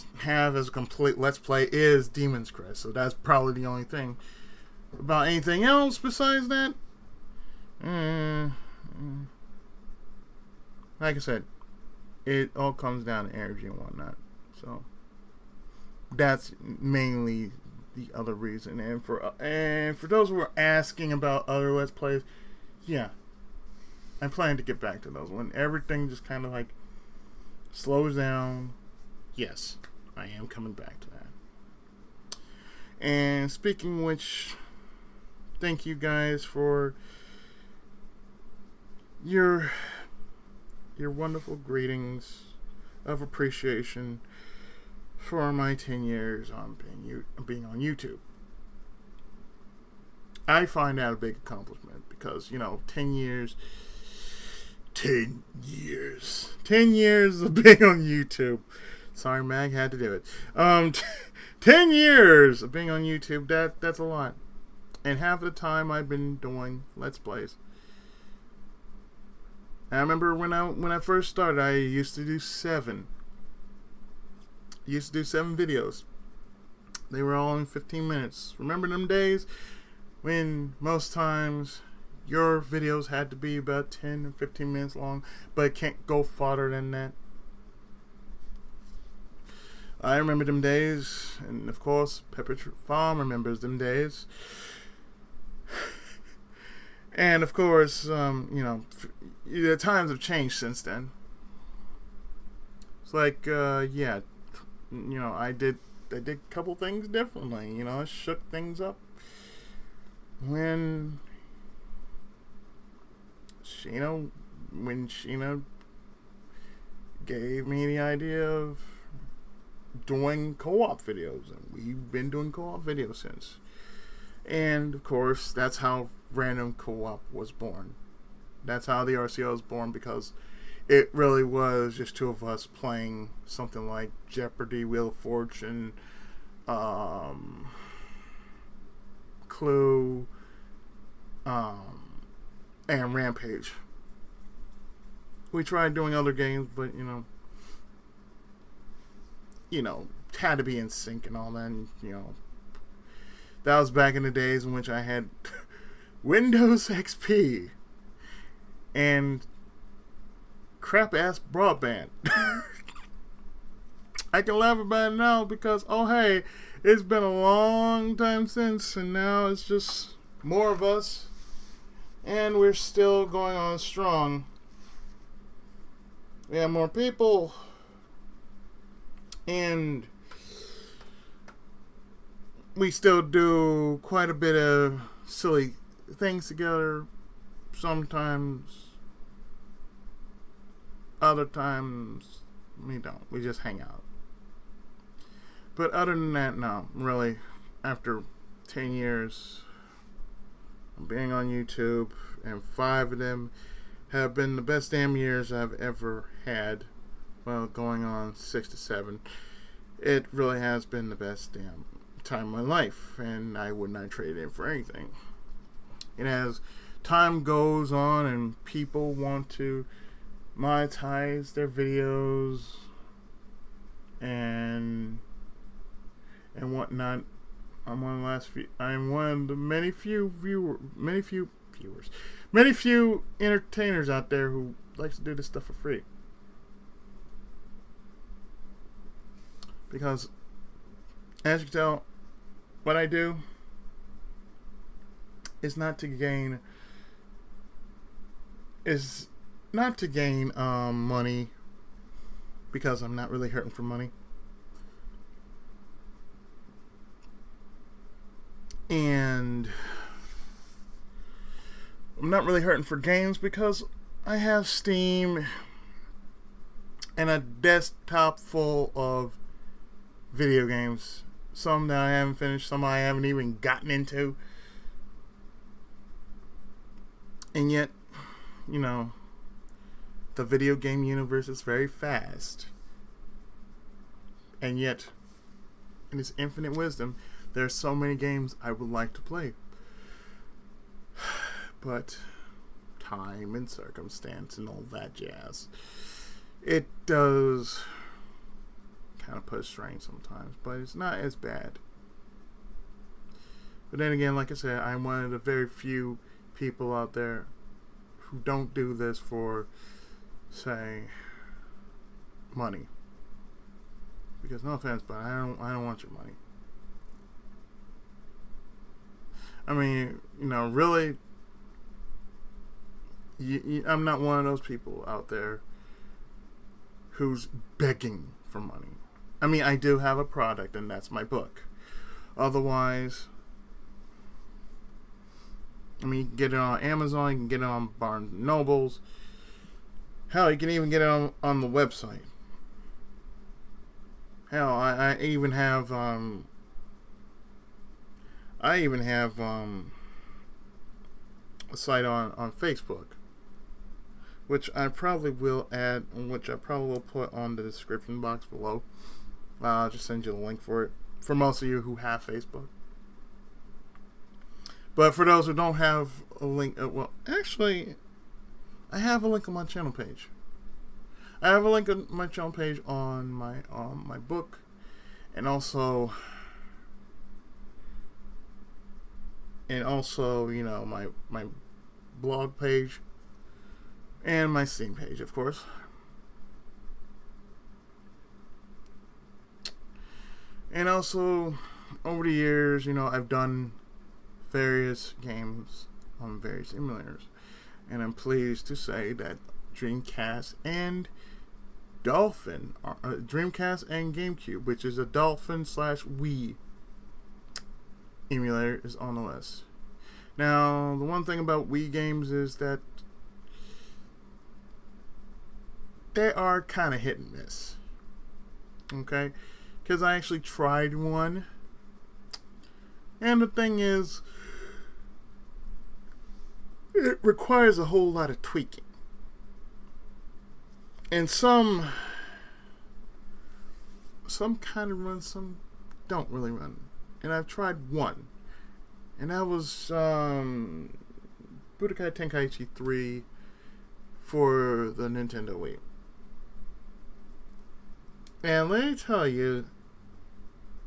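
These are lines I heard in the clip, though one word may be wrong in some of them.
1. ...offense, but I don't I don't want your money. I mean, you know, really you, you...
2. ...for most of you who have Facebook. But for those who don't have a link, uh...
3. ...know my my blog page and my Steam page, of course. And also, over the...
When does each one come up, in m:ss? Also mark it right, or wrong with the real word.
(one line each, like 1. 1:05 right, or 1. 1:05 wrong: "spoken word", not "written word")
1. 5:14 right
2. 6:01 right
3. 6:20 right.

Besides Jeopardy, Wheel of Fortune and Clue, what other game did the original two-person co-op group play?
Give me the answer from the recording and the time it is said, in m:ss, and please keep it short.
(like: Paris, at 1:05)
Rampage, at 2:23.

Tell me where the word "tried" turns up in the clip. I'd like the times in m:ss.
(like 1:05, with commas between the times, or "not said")
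2:25, 7:00, 7:17.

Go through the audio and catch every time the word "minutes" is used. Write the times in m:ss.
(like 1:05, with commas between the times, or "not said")
1:18, 1:24.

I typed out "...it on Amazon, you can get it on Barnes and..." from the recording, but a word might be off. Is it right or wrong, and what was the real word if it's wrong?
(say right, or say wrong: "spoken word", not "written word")
right.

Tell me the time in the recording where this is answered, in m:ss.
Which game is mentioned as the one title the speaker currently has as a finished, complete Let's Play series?
0:02.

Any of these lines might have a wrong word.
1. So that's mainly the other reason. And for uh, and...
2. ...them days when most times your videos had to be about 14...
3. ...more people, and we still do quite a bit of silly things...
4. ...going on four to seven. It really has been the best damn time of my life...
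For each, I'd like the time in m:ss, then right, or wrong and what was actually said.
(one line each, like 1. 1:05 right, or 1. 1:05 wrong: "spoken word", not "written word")
1. 0:14 right
2. 1:18 wrong: "10", not "14"
3. 2:56 right
4. 3:27 wrong: "six", not "four".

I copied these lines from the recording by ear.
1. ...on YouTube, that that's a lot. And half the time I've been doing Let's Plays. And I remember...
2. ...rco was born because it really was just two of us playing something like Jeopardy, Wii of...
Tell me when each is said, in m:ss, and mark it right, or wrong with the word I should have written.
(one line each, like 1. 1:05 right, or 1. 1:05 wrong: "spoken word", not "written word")
1. 1:02 right
2. 2:09 wrong: "Wheel", not "Wii".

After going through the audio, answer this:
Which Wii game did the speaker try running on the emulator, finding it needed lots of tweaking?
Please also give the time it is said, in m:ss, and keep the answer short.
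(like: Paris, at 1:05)
Budokai Tenkaichi 3, at 7:21.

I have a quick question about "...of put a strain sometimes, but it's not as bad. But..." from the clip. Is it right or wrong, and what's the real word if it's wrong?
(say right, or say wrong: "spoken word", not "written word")
right.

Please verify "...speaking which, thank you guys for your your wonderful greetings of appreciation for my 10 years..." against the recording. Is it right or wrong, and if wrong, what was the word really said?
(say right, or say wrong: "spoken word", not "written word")
right.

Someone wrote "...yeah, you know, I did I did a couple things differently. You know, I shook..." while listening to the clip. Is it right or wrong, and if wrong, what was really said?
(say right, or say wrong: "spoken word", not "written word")
right.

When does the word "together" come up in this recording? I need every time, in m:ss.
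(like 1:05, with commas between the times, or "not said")
3:06.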